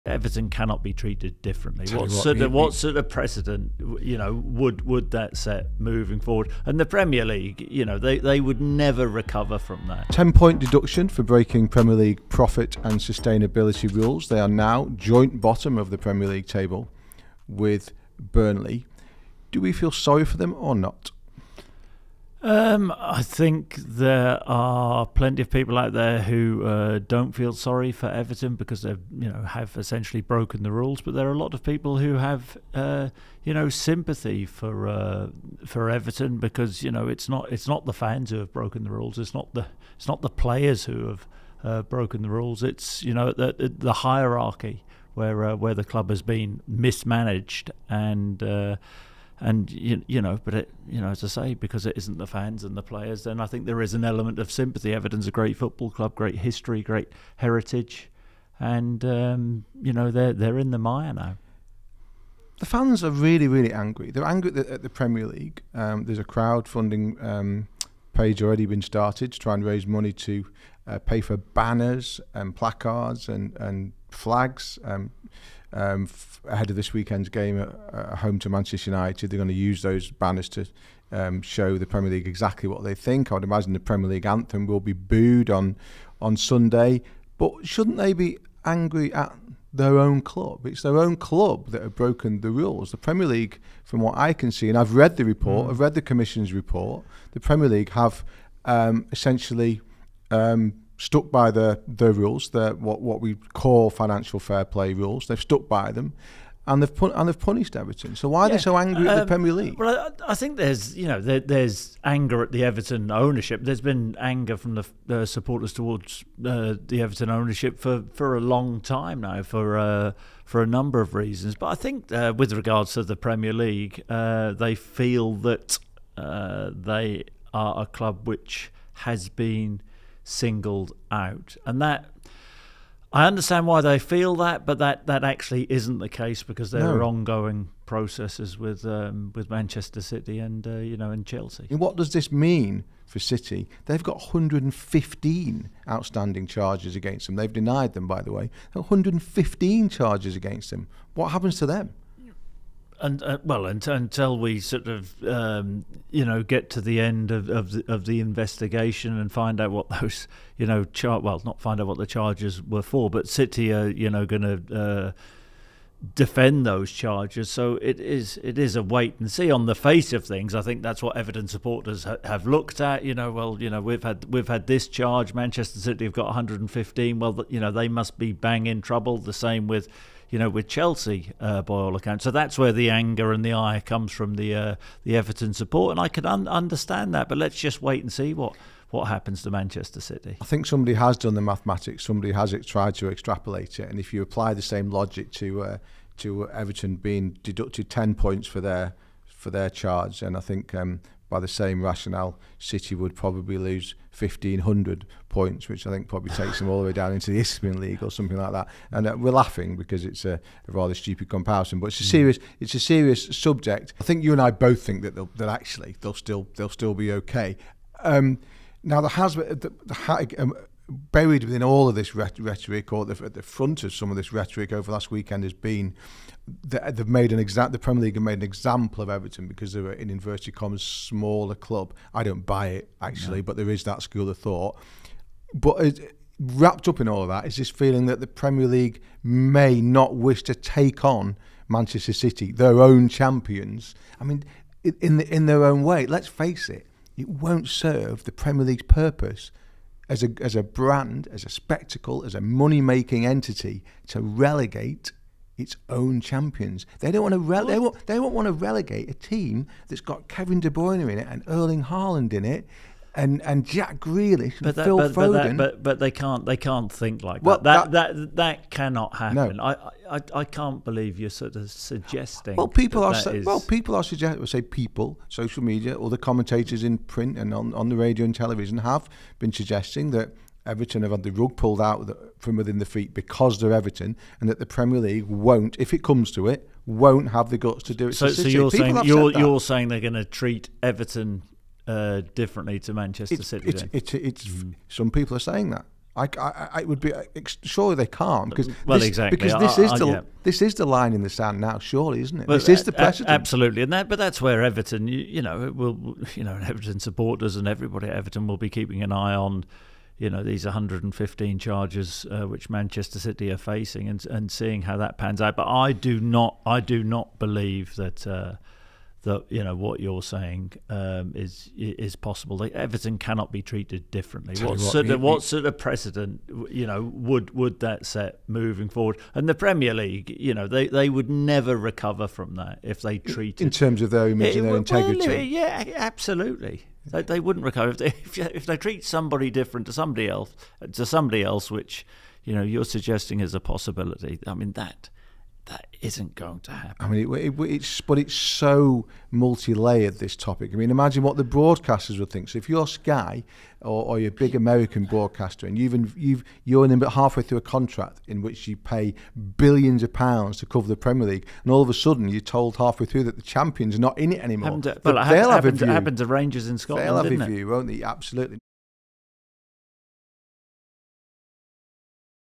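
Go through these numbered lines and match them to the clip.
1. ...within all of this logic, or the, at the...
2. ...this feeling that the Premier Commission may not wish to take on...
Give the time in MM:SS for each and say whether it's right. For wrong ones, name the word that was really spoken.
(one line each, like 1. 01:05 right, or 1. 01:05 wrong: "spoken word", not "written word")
1. 03:41 wrong: "rhetoric", not "logic"
2. 03:57 wrong: "League", not "Commission".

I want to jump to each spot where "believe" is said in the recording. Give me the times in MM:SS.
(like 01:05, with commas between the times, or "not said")
04:30, 05:17.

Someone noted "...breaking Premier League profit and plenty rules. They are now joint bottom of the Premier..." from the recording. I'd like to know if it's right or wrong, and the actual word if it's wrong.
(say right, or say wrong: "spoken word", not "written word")
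wrong: "sustainability", not "plenty".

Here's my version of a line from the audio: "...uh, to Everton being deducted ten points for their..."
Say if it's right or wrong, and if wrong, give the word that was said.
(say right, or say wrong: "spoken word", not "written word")
right.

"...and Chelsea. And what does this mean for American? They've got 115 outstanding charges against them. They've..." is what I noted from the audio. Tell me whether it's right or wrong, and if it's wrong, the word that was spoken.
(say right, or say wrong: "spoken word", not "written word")
wrong: "City", not "American".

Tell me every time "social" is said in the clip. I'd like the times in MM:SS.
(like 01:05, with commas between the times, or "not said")
04:35.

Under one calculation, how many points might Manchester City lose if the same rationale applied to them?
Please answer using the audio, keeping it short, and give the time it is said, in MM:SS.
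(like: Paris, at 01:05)
1,500, at 03:24.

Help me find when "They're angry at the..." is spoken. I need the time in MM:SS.
01:04.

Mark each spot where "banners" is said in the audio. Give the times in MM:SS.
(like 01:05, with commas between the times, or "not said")
01:11, 01:20.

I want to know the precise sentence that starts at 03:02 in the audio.
So that's where the anger and the ire comes from the uh, the Everton support, and I can un- understand that.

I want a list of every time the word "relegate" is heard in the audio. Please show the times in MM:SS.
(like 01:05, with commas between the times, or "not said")
04:14, 04:18.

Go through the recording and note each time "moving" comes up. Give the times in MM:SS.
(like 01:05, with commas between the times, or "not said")
00:05, 05:28.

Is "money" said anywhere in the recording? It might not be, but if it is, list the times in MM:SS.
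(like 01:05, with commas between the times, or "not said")
01:09, 04:12.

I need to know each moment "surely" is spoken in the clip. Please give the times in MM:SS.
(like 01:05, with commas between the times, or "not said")
04:57, 05:01.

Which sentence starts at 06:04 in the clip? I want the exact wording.
Happened to, well, it happened, happened, happened, to Rangers in Scotland.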